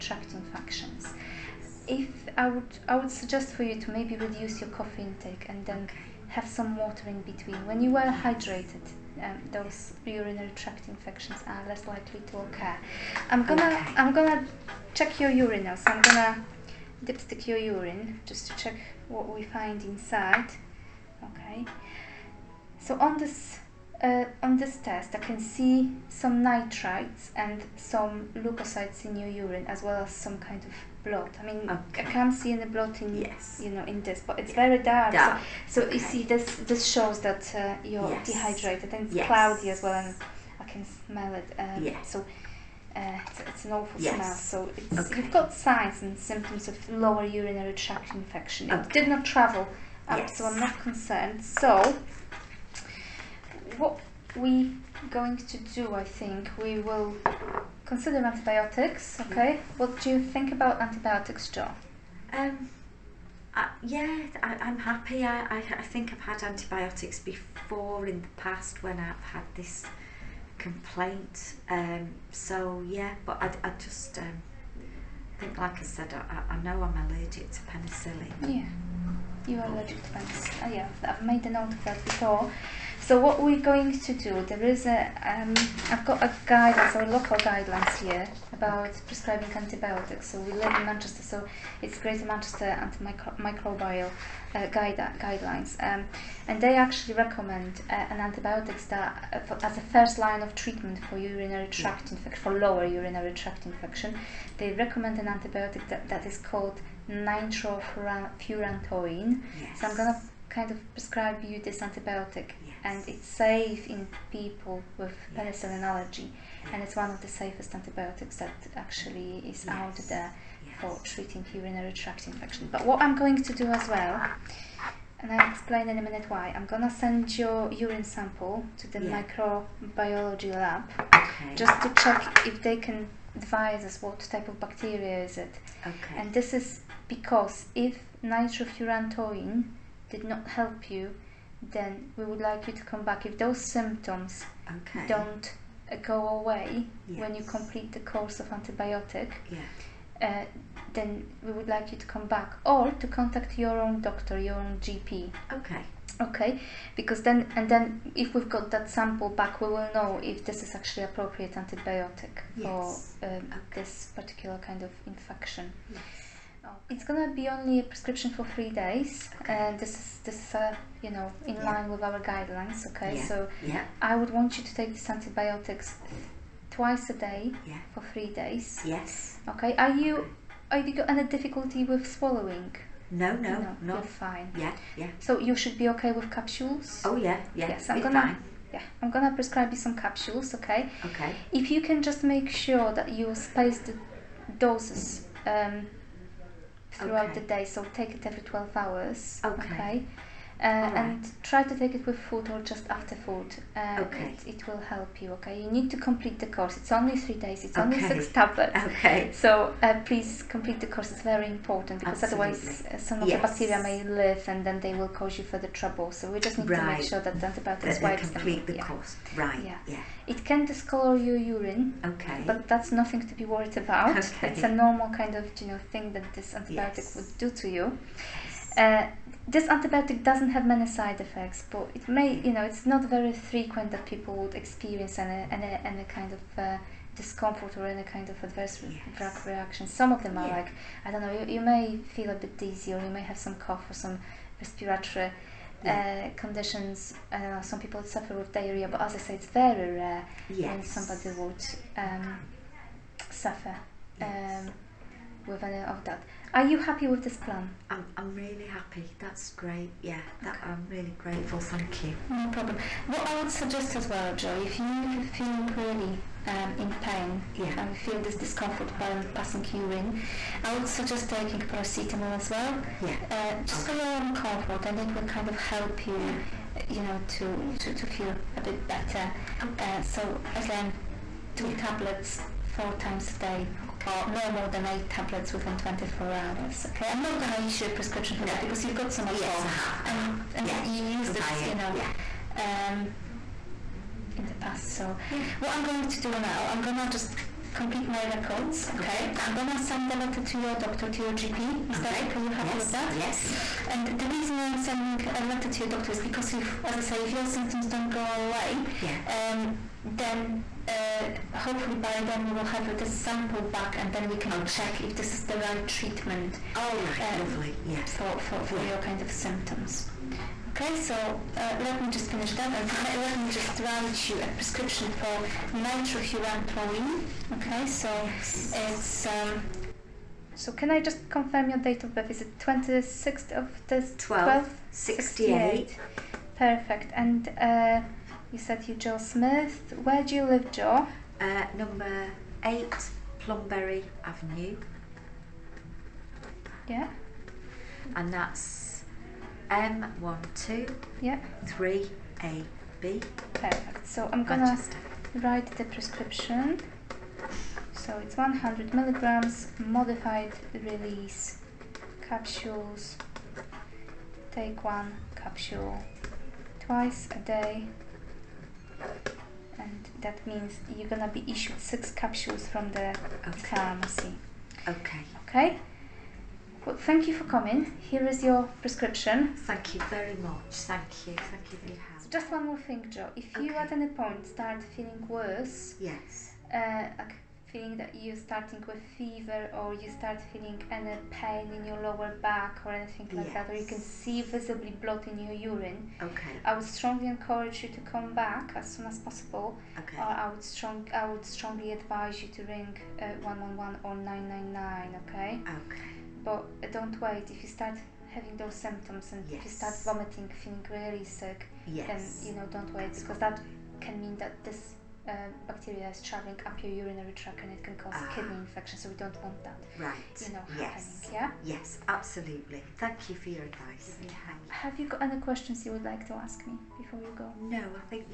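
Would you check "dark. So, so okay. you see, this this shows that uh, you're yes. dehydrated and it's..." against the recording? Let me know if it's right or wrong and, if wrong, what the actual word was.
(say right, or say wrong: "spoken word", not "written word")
right.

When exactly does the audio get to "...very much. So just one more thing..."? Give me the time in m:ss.
6:21.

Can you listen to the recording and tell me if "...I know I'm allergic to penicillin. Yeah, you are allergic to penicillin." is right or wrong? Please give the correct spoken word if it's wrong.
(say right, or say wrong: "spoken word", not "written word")
right.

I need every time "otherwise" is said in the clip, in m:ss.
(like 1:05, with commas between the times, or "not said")
3:32.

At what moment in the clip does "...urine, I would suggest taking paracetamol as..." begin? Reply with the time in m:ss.
4:29.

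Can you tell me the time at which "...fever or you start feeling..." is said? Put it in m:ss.
6:29.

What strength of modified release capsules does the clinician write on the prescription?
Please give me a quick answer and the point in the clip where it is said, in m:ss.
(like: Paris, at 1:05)
100 milligrams, at 5:58.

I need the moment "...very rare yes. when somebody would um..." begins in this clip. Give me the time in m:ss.
4:09.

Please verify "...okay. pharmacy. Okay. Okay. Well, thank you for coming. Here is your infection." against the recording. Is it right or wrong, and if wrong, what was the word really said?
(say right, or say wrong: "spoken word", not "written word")
wrong: "prescription", not "infection".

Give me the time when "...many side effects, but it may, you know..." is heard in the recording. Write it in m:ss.
3:50.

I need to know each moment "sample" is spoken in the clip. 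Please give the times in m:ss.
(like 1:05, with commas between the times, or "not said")
2:08, 2:38, 5:13.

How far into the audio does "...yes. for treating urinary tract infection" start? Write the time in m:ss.
2:00.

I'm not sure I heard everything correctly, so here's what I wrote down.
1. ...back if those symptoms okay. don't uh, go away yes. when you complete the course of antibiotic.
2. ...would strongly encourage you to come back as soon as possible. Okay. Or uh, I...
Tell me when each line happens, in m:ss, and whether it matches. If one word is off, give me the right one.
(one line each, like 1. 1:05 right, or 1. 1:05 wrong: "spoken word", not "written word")
1. 2:23 right
2. 6:36 right.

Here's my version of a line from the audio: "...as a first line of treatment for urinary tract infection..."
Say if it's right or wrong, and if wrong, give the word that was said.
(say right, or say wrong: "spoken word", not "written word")
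right.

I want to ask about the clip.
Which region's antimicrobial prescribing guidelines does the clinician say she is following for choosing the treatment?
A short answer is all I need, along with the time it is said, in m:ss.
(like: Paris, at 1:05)
Greater Manchester, at 1:31.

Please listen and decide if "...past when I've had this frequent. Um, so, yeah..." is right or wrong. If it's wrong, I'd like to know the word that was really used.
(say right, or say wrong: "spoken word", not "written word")
wrong: "complaint", not "frequent".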